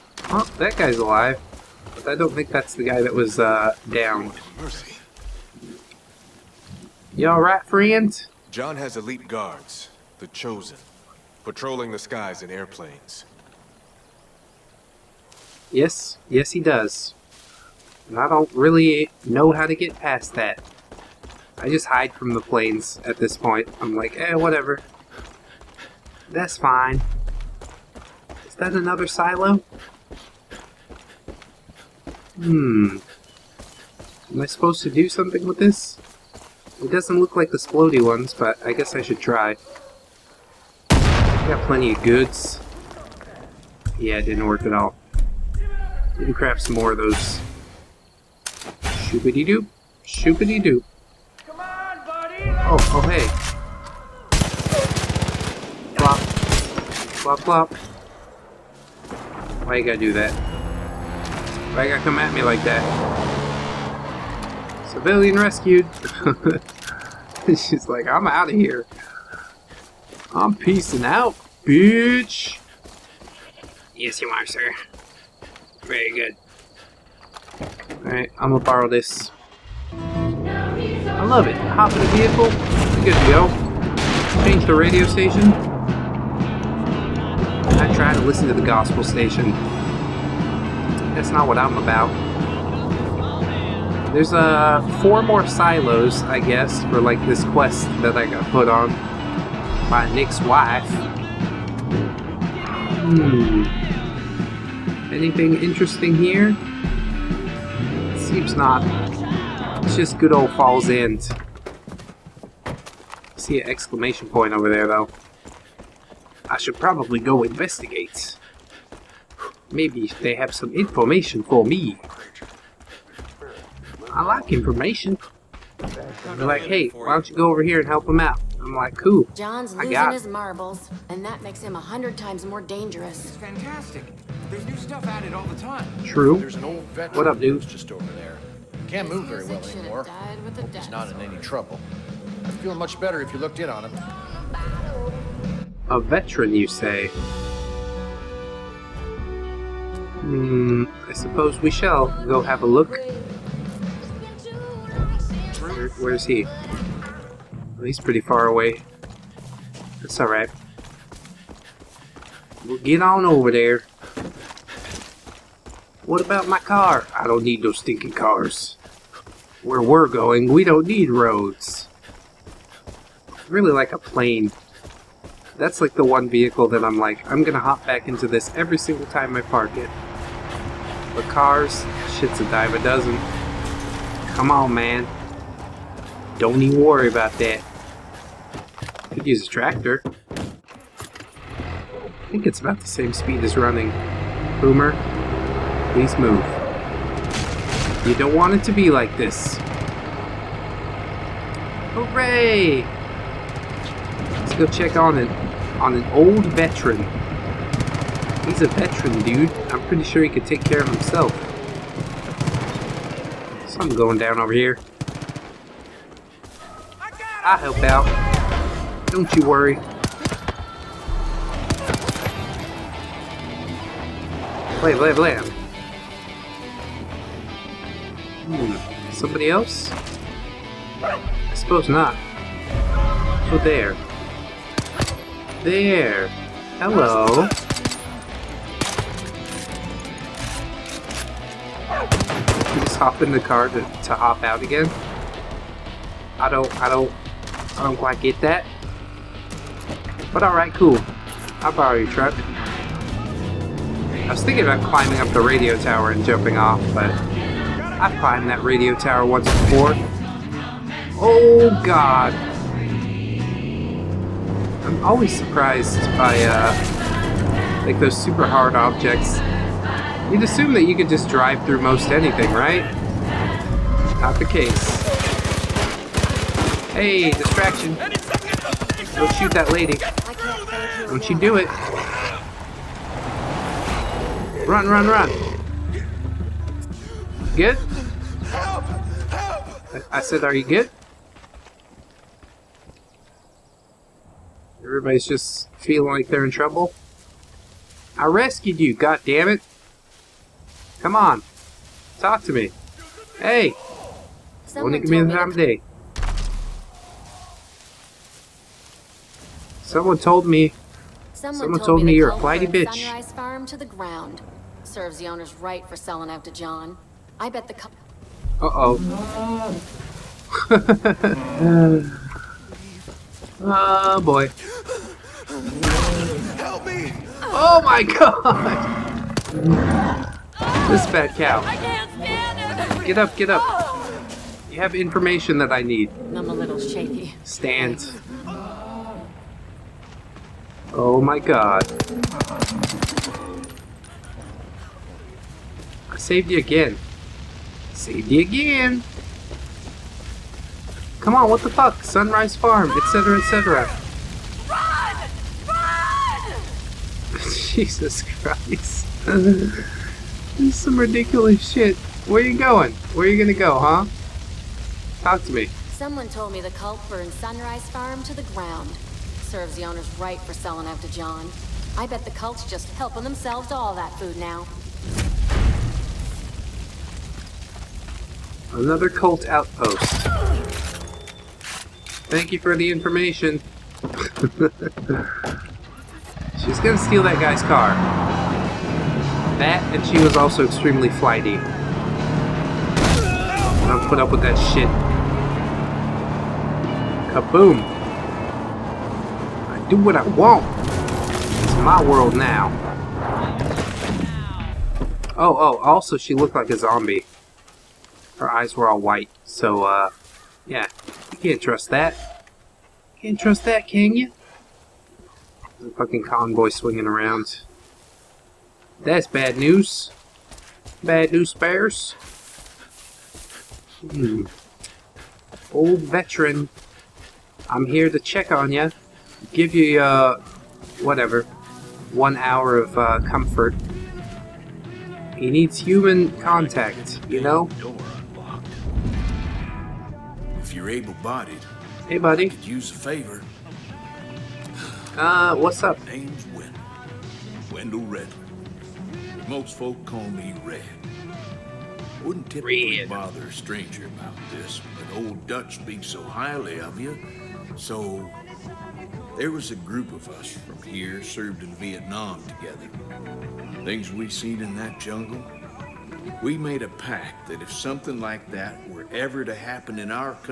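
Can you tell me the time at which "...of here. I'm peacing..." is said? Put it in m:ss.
1:08.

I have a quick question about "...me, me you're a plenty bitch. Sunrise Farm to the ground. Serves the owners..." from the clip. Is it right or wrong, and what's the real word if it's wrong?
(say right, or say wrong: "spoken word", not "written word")
wrong: "flighty", not "plenty".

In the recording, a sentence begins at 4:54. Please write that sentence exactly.
Everybody's just feeling like they're in trouble.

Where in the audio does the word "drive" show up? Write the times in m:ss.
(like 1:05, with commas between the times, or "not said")
4:31.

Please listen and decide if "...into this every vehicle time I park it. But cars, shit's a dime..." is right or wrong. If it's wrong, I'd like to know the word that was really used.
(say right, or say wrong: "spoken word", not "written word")
wrong: "single", not "vehicle".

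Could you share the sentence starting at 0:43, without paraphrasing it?
Yeah, it didn't work at all.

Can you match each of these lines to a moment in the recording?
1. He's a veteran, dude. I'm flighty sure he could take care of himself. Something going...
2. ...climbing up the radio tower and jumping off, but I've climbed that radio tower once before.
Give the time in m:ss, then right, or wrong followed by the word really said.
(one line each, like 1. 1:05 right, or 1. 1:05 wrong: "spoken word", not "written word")
1. 3:28 wrong: "pretty", not "flighty"
2. 4:14 right.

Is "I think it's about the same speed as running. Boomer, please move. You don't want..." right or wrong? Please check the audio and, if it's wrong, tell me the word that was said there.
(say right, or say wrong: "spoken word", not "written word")
right.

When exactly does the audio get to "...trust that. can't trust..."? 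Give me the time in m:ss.
6:51.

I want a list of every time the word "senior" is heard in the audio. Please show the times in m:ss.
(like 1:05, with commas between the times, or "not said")
not said.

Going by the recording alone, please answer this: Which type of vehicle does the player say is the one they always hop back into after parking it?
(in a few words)
plane.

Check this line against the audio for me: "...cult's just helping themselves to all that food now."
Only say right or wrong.
right.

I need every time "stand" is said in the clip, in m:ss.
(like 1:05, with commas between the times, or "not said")
5:32, 5:37.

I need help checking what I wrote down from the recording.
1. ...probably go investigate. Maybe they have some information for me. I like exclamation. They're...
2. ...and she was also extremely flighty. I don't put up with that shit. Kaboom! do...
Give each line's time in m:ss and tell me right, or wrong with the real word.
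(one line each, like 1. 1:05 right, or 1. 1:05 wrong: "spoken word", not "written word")
1. 1:56 wrong: "information", not "exclamation"
2. 6:29 right.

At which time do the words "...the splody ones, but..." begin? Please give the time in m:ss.
0:37.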